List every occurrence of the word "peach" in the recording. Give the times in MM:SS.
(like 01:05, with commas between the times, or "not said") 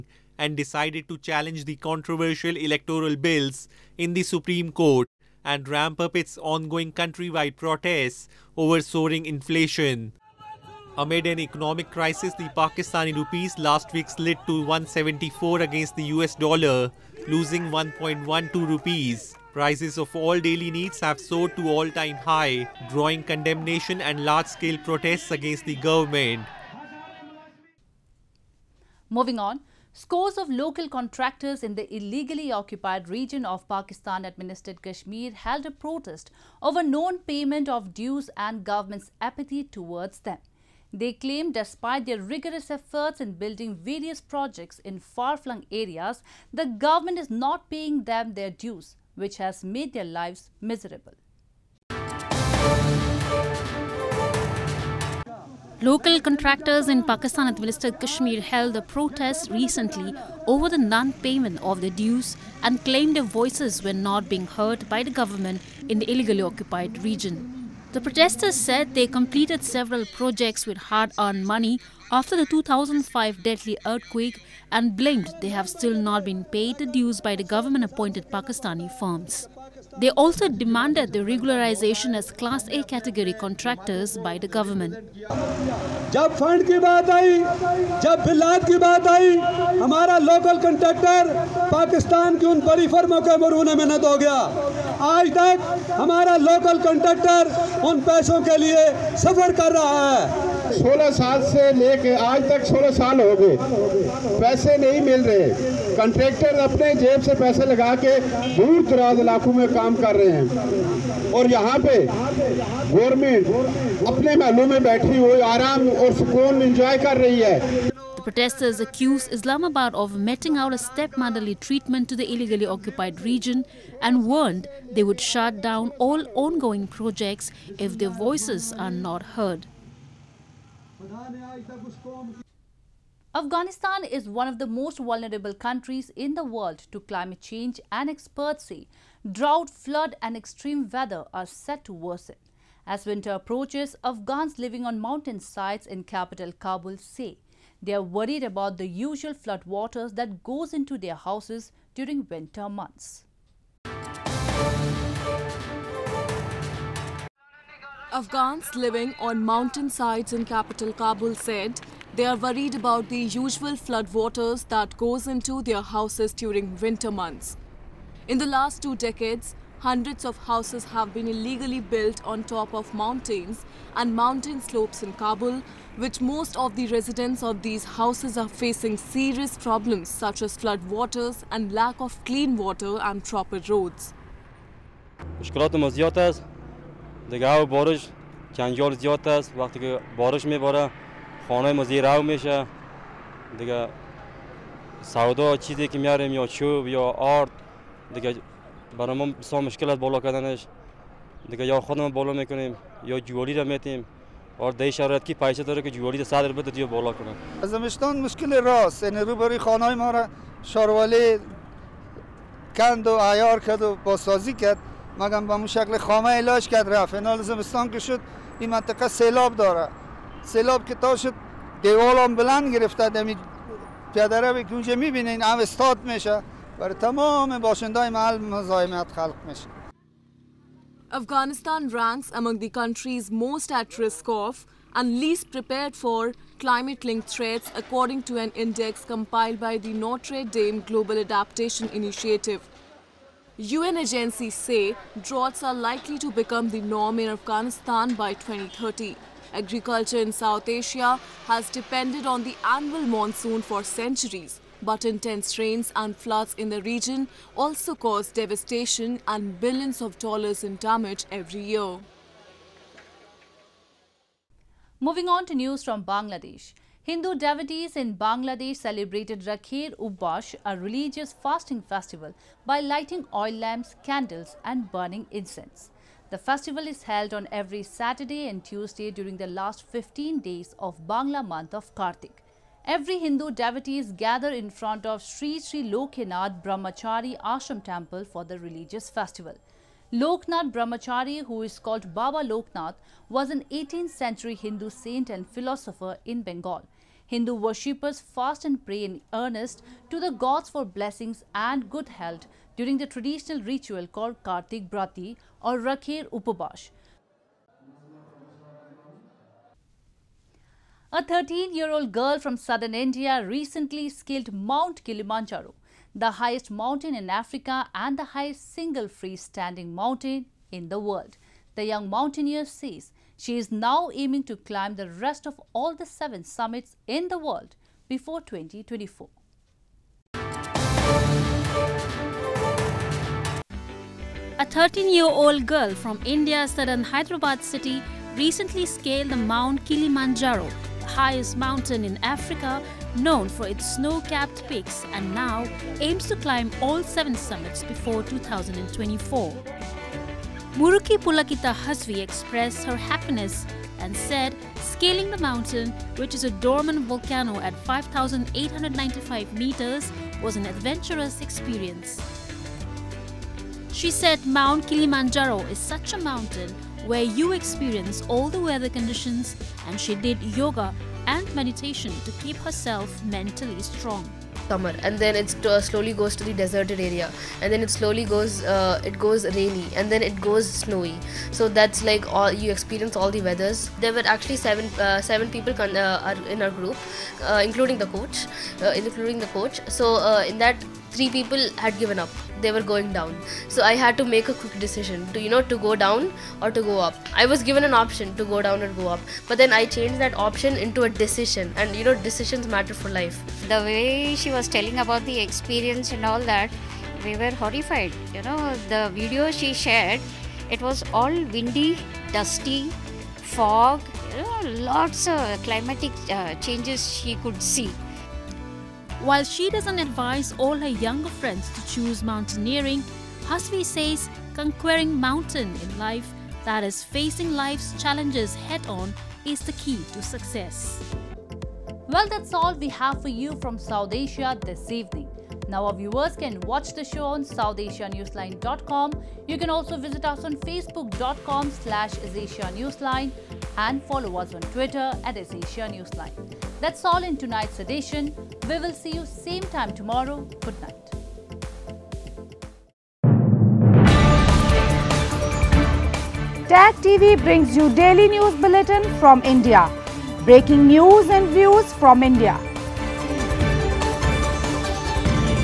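not said.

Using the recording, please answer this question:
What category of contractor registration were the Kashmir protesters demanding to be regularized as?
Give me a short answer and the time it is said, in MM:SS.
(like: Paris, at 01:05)
Class A, at 01:22.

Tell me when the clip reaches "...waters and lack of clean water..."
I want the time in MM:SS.
03:00.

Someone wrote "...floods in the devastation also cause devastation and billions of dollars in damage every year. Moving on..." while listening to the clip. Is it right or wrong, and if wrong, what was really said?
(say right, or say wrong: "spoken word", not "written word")
wrong: "region", not "devastation".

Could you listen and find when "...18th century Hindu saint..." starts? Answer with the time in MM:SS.
04:53.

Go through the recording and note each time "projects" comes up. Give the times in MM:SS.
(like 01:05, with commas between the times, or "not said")
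00:44, 01:10, 02:06.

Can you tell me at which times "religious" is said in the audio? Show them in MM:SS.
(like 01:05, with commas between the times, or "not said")
04:30, 04:48.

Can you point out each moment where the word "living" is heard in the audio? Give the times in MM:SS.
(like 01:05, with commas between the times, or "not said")
02:24, 02:38.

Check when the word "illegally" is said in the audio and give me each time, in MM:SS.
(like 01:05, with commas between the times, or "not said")
00:31, 01:06, 02:02, 02:51.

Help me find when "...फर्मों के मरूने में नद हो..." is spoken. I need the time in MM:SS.
01:32.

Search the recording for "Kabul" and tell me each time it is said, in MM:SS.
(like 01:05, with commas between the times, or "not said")
02:26, 02:40, 02:55.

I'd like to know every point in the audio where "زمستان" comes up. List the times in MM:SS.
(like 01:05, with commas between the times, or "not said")
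03:27, 03:37.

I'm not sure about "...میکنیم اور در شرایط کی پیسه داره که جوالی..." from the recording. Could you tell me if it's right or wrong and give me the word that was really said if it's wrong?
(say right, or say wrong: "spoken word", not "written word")
wrong: "میتیم", not "میکنیم".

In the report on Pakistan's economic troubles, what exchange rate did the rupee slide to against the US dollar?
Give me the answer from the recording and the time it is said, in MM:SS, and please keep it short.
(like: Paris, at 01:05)
174, at 00:14.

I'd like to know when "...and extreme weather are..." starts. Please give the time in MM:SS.
02:20.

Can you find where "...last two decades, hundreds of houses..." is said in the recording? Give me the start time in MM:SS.
02:48.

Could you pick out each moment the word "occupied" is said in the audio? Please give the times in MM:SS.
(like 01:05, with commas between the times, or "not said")
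00:32, 01:06, 02:02.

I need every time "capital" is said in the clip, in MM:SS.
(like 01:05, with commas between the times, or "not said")
02:26, 02:40.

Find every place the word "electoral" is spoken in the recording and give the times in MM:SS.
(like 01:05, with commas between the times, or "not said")
00:02.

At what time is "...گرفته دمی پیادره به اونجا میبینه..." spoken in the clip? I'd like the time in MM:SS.
03:42.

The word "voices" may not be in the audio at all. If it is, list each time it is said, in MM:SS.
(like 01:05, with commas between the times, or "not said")
01:03, 02:08.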